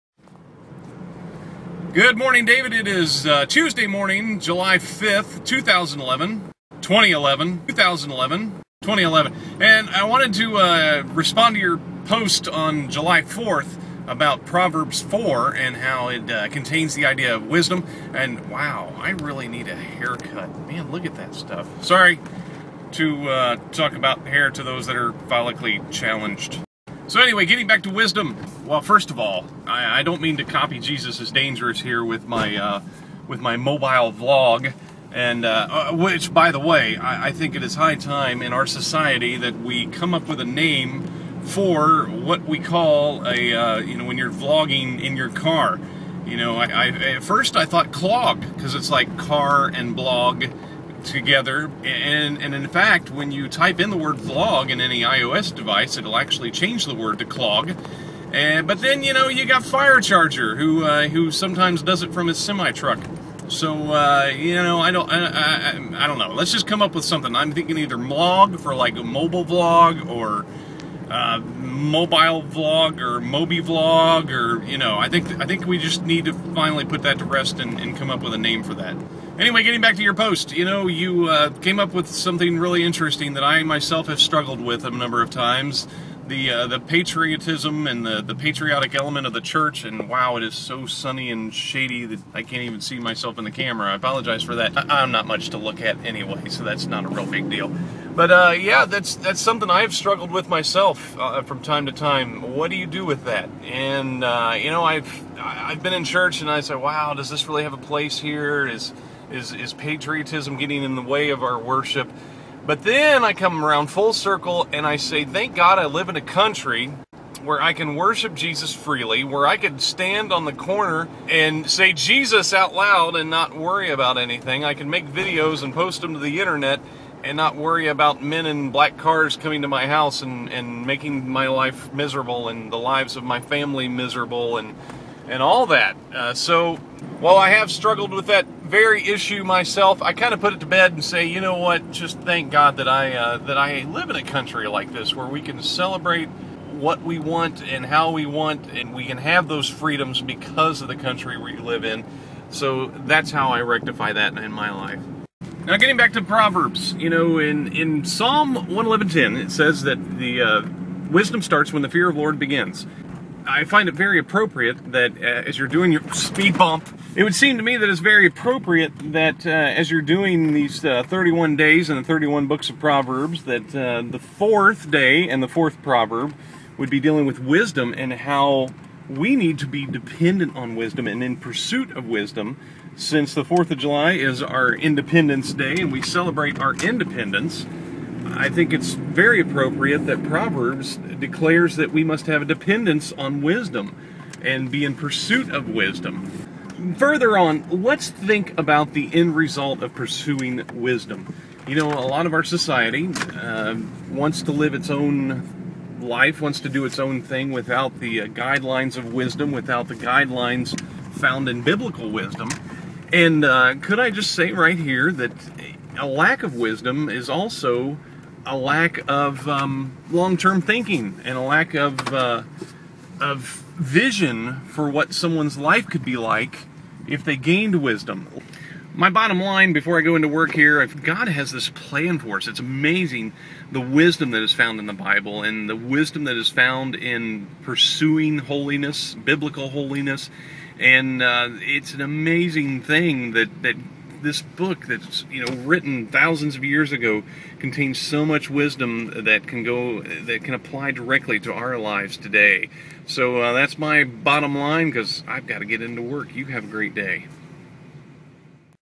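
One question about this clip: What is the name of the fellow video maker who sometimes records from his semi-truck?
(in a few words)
charger.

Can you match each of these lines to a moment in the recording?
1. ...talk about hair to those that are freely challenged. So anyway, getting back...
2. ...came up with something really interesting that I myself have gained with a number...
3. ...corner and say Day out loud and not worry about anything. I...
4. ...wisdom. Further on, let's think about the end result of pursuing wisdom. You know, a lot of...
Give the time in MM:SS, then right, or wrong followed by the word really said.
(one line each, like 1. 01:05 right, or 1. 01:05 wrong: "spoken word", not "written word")
1. 00:23 wrong: "follically", not "freely"
2. 01:21 wrong: "struggled", not "gained"
3. 02:00 wrong: "Jesus", not "Day"
4. 03:15 right.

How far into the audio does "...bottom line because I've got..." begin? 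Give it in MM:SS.
04:14.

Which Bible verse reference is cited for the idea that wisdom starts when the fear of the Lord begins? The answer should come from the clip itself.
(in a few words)
Psalm 111:10.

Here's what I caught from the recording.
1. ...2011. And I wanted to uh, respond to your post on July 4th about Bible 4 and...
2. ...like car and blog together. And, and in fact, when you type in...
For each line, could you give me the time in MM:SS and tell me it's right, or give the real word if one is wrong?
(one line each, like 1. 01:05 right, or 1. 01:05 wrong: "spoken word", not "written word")
1. 00:08 wrong: "Proverbs", not "Bible"
2. 00:48 right.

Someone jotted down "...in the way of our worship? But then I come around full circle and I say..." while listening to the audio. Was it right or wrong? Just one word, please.
right.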